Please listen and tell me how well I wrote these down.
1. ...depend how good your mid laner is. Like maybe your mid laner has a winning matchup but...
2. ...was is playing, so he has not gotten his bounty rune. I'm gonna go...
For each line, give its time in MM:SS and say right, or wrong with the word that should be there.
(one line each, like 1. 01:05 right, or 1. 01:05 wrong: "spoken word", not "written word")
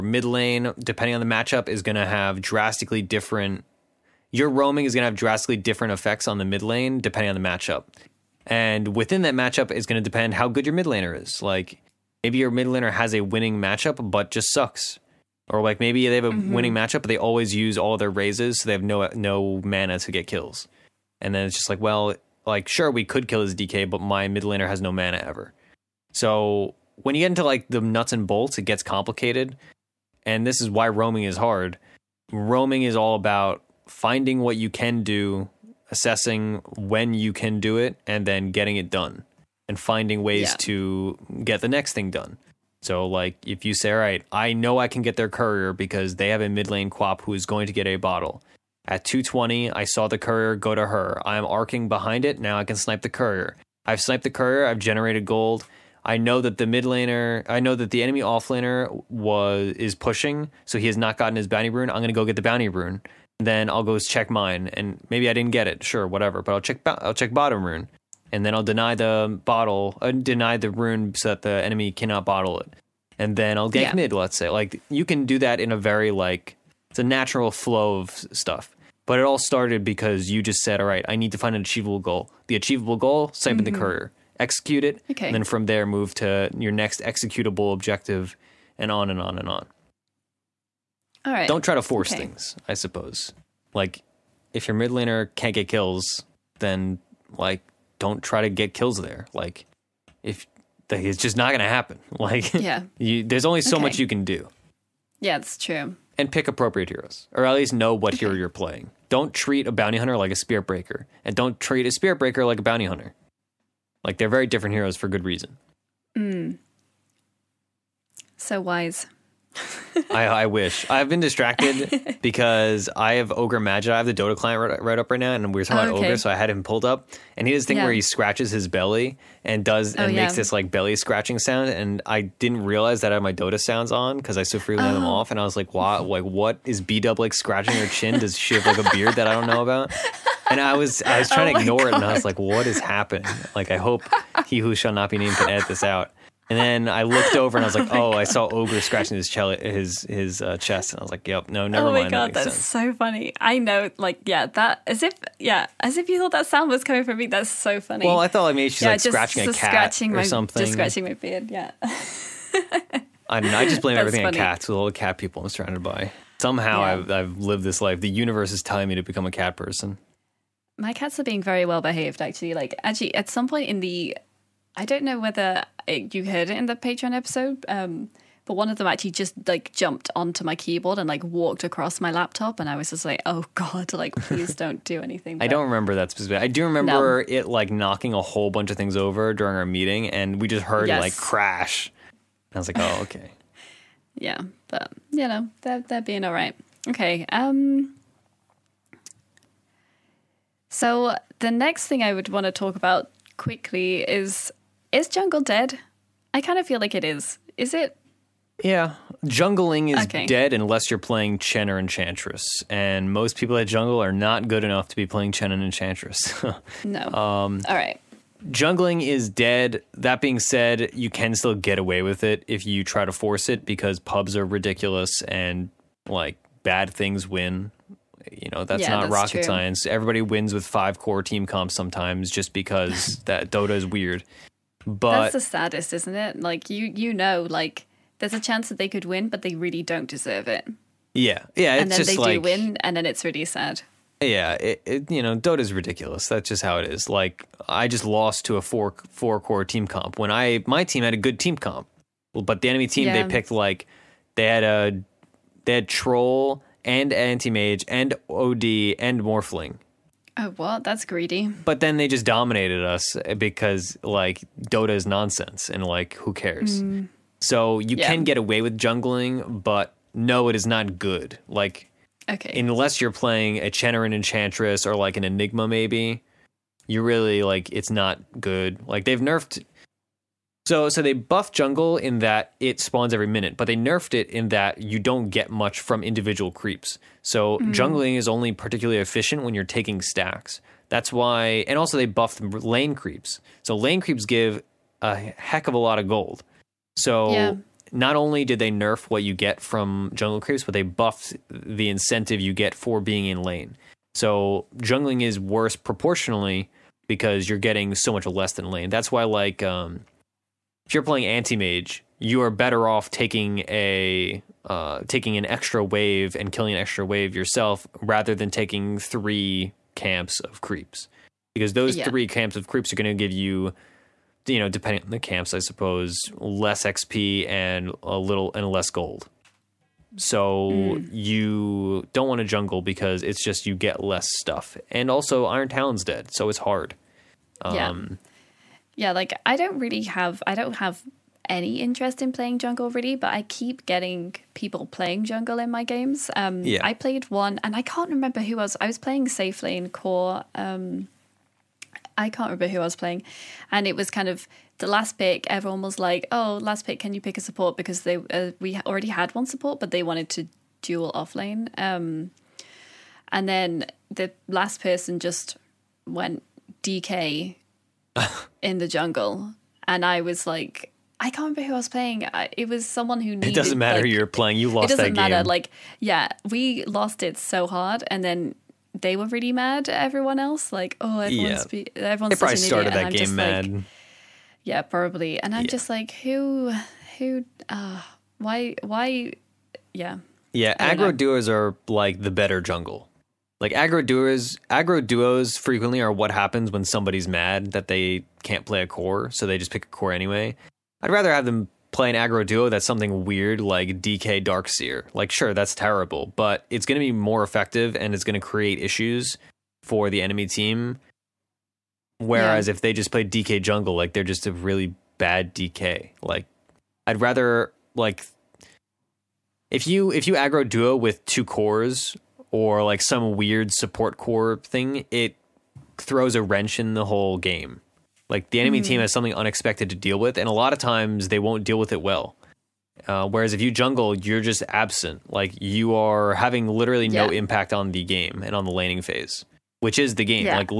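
1. 00:10 right
2. 00:59 wrong: "pushing", not "playing".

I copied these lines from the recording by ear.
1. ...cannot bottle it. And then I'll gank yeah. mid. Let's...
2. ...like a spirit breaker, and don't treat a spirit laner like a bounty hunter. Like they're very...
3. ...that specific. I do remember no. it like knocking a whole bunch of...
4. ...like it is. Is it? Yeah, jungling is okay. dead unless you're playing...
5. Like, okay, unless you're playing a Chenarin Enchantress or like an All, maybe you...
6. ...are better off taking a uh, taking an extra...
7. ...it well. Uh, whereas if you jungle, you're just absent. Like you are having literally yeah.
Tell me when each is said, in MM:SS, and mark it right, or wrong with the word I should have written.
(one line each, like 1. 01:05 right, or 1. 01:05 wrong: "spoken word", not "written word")
1. 01:11 right
2. 01:50 wrong: "breaker", not "laner"
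3. 03:05 right
4. 03:26 right
5. 04:31 wrong: "Enigma", not "All"
6. 05:12 right
7. 07:11 right.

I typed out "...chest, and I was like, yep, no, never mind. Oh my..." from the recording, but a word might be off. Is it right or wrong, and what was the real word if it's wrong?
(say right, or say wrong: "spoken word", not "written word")
right.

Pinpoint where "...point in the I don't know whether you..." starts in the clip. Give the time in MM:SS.
02:53.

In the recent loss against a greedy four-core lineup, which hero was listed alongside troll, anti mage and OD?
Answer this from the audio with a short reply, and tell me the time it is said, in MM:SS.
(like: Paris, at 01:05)
Morphling, at 04:19.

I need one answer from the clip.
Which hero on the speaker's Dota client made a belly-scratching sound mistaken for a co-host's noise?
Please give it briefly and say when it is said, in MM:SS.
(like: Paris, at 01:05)
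Ogre Magi, at 02:03.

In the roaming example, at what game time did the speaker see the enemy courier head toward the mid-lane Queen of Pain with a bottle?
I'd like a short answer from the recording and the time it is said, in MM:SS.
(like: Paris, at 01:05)
2:20, at 00:49.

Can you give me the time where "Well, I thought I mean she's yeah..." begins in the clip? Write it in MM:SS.
02:38.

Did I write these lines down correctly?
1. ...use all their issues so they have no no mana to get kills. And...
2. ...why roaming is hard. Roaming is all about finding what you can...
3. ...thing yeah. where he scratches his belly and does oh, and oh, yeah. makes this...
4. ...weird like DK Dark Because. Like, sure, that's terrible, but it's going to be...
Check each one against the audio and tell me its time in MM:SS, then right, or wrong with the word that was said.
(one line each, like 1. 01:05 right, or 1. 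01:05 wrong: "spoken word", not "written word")
1. 00:17 wrong: "razes", not "issues"
2. 00:30 right
3. 02:07 right
4. 06:43 wrong: "Seer", not "Because".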